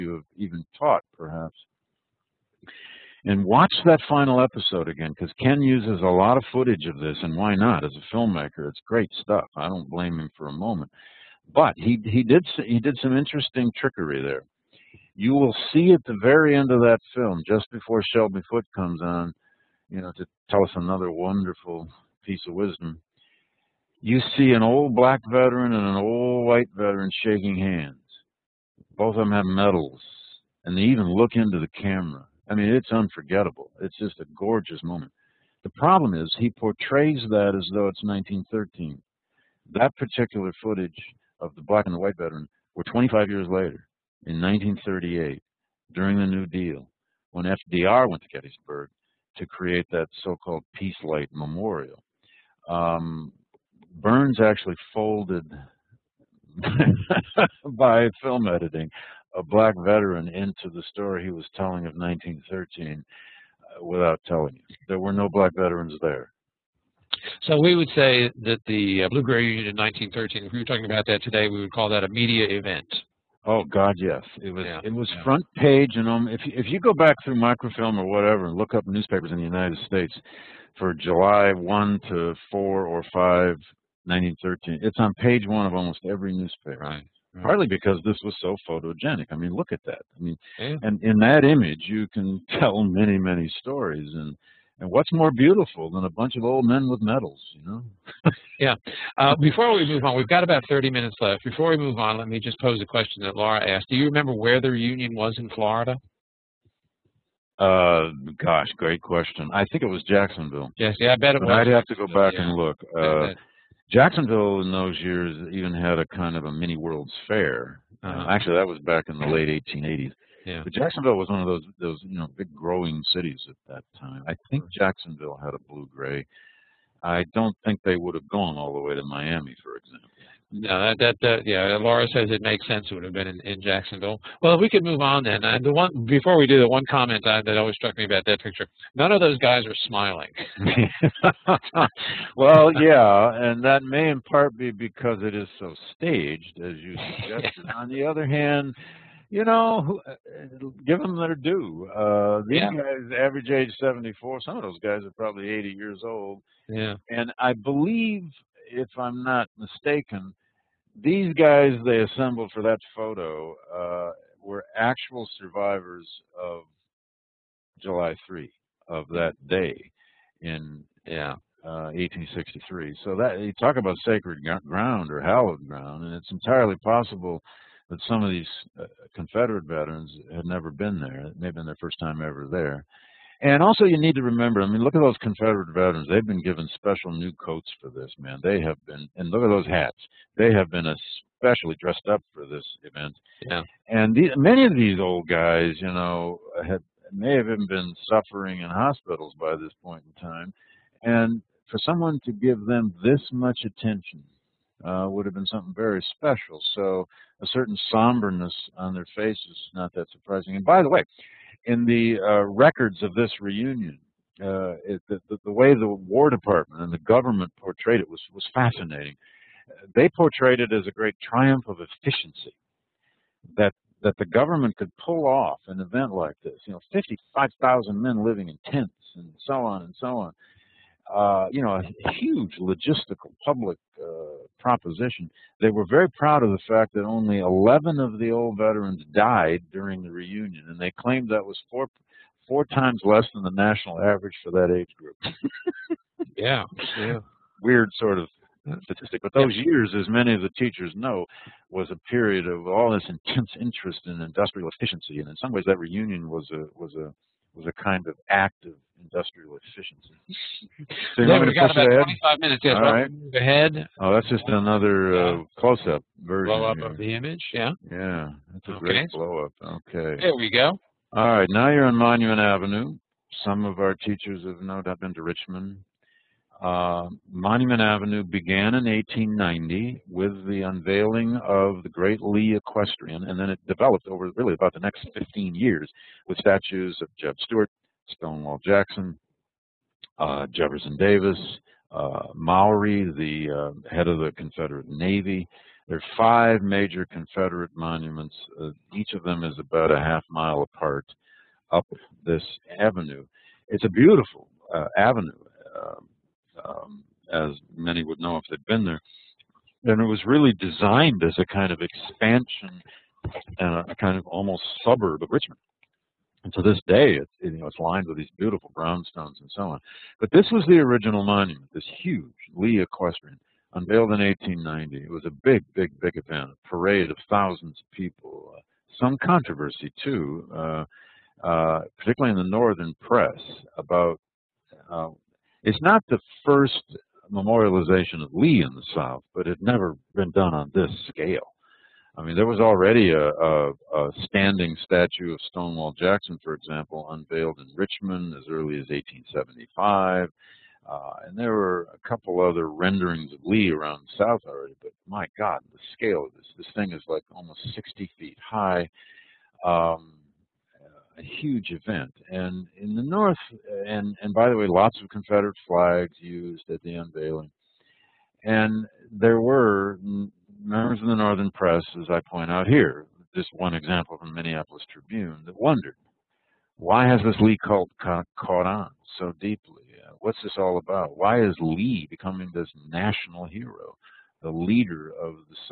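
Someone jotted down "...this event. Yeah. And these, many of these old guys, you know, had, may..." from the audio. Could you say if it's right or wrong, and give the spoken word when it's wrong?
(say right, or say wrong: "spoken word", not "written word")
right.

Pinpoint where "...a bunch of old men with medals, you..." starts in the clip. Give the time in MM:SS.
01:36.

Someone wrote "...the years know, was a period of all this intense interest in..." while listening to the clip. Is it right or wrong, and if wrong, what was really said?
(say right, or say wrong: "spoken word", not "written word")
wrong: "teachers", not "years".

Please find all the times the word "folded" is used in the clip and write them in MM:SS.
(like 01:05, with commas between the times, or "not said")
00:54.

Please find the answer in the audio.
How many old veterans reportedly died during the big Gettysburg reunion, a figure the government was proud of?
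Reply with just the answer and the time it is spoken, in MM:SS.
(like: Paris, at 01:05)
11, at 03:57.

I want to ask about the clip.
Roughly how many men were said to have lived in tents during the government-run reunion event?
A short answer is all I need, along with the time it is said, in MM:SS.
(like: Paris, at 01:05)
55,000, at 03:46.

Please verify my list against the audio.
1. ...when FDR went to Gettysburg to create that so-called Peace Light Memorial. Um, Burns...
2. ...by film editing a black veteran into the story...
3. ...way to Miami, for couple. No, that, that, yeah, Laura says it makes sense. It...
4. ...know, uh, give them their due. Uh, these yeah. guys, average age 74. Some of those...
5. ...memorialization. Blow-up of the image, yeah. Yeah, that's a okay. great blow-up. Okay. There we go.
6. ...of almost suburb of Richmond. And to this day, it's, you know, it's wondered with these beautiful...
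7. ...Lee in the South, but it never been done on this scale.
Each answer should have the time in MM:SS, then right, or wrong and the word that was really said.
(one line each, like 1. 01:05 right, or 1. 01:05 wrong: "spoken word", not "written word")
1. 00:47 right
2. 00:57 right
3. 02:08 wrong: "example", not "couple"
4. 02:29 right
5. 04:26 wrong: "version", not "memorialization"
6. 05:14 wrong: "lined", not "wondered"
7. 05:38 right.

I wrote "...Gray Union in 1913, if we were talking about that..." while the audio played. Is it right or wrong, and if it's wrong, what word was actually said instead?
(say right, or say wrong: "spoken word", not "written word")
right.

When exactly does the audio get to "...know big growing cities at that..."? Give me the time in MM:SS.
02:02.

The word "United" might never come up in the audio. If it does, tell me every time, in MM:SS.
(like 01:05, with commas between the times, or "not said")
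01:19.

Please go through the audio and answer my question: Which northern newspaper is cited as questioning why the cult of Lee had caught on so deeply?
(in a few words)
Minneapolis Tribune.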